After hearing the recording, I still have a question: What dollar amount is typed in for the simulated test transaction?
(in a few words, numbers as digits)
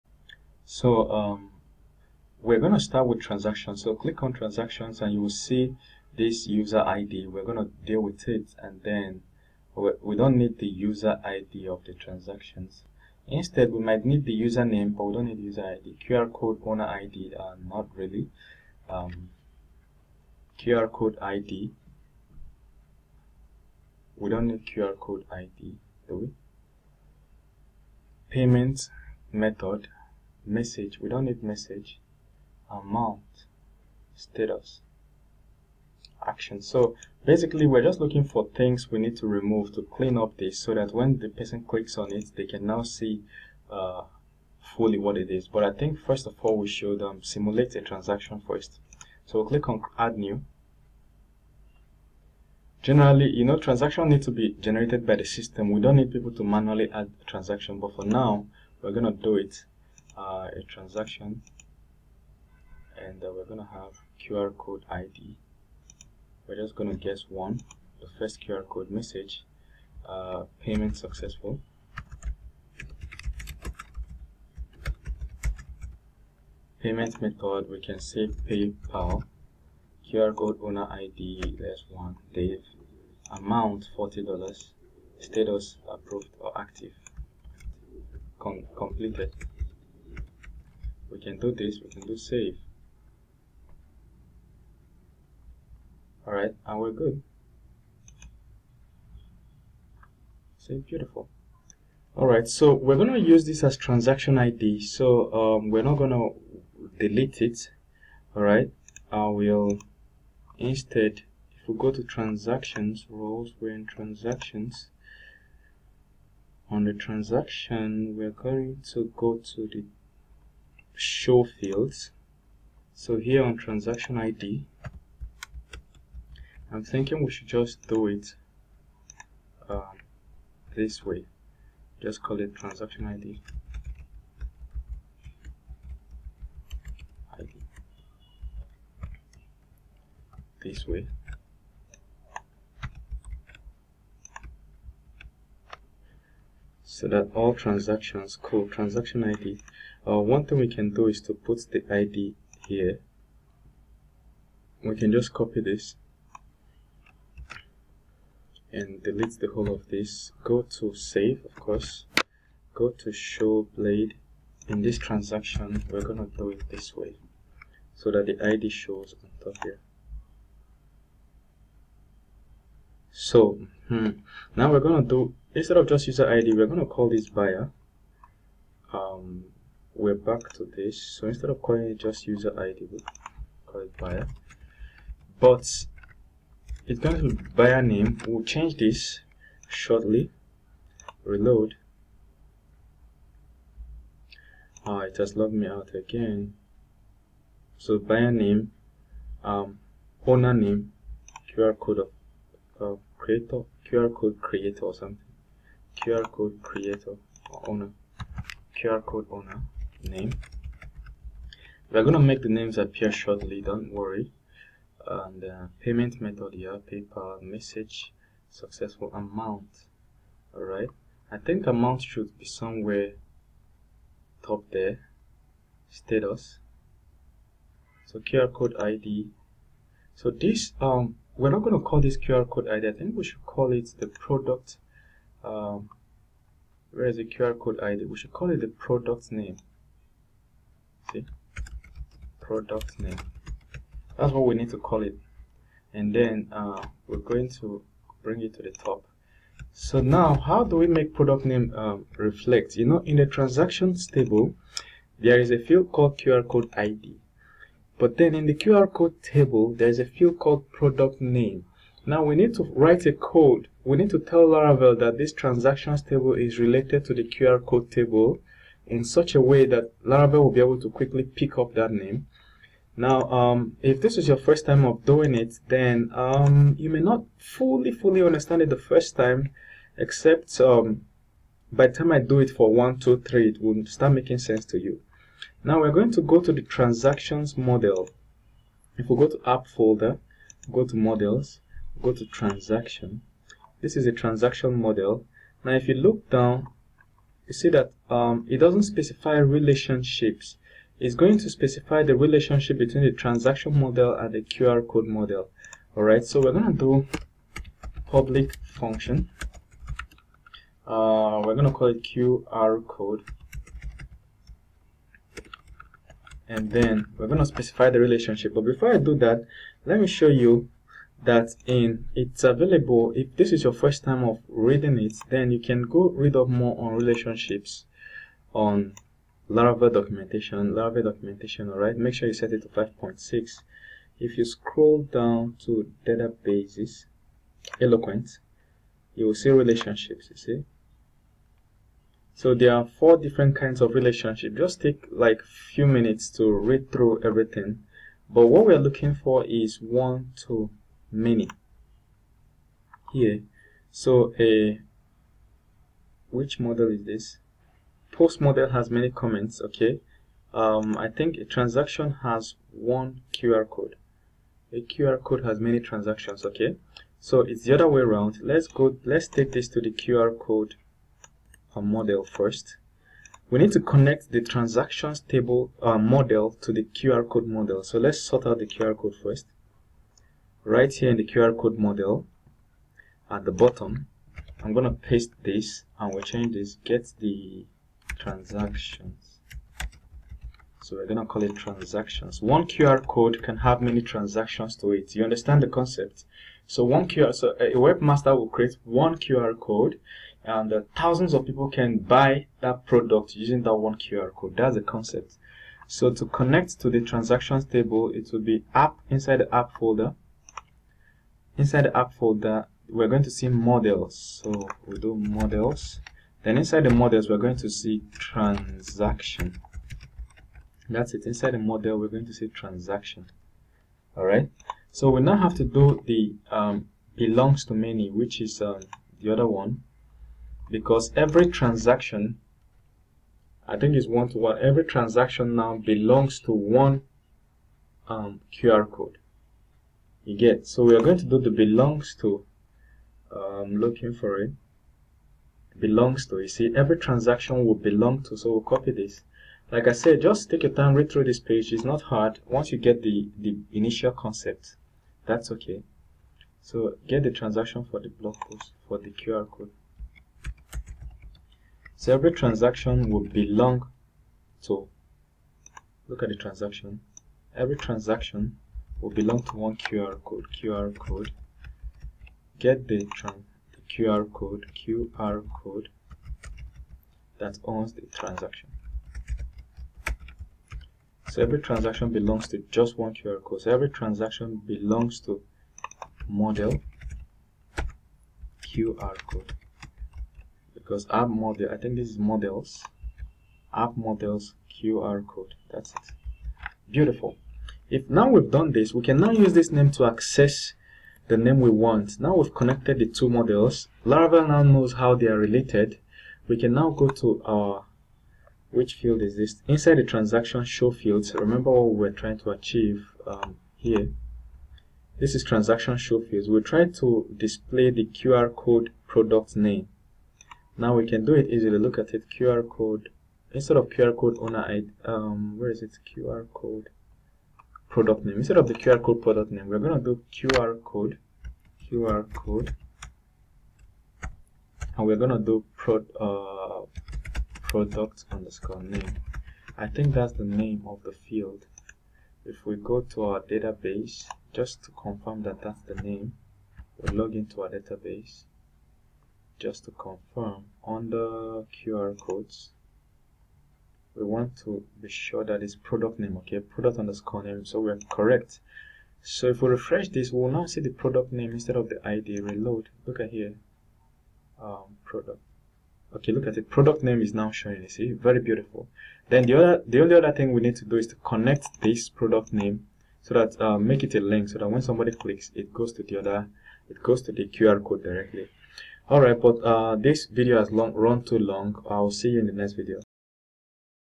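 $40.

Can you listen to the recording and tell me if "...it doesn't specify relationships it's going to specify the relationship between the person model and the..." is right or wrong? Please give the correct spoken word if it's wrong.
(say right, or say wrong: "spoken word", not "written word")
wrong: "transaction", not "person".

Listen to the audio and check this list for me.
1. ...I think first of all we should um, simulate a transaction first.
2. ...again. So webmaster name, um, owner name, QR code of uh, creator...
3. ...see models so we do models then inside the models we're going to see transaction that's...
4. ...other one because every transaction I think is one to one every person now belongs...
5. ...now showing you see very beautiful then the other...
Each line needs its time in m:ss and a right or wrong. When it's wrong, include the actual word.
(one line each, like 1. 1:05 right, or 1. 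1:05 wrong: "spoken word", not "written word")
1. 0:45 right
2. 3:15 wrong: "buyer", not "webmaster"
3. 6:53 right
4. 7:09 wrong: "transaction", not "person"
5. 9:27 right.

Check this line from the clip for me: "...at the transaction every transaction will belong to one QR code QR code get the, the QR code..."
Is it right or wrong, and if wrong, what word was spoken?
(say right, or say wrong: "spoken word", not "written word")
right.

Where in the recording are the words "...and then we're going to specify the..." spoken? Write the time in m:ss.
5:16.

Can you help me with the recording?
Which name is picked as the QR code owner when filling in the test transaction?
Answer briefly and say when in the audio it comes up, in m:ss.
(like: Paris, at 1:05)
Dave, at 1:22.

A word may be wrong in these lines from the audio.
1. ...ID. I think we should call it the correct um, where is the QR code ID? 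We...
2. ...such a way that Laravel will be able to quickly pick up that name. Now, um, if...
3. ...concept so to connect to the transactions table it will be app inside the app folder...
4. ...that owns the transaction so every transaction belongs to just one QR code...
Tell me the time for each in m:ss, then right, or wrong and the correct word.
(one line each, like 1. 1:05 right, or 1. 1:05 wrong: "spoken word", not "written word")
1. 3:52 wrong: "product", not "correct"
2. 4:29 right
3. 6:44 right
4. 7:57 right.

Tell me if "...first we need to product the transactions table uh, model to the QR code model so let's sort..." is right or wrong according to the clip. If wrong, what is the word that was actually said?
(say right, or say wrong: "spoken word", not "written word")
wrong: "connect", not "product".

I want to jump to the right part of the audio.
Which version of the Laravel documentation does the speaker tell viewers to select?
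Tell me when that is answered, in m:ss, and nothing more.
5:32.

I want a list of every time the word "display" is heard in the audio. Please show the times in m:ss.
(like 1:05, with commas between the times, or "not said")
8:37.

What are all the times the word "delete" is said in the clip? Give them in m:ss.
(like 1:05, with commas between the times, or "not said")
1:46, 2:39.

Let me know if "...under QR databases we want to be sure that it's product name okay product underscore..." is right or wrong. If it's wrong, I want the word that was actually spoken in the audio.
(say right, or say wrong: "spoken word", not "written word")
wrong: "codes", not "databases".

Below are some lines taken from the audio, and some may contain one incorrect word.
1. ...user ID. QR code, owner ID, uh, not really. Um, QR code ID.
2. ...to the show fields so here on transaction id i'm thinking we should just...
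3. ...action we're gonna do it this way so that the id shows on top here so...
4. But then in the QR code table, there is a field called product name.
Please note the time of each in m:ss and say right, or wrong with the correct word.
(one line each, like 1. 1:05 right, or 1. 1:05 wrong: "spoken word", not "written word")
1. 0:15 right
2. 1:59 right
3. 2:44 wrong: "transaction", not "action"
4. 4:17 right.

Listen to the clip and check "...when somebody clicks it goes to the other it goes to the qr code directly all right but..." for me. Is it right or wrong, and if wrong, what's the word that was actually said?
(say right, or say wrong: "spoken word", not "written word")
right.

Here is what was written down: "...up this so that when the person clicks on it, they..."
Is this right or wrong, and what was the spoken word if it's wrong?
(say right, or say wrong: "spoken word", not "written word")
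right.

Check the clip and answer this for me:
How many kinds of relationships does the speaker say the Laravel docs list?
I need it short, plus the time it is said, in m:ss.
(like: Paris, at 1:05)
four, at 5:42.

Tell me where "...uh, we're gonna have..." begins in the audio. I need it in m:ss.
1:03.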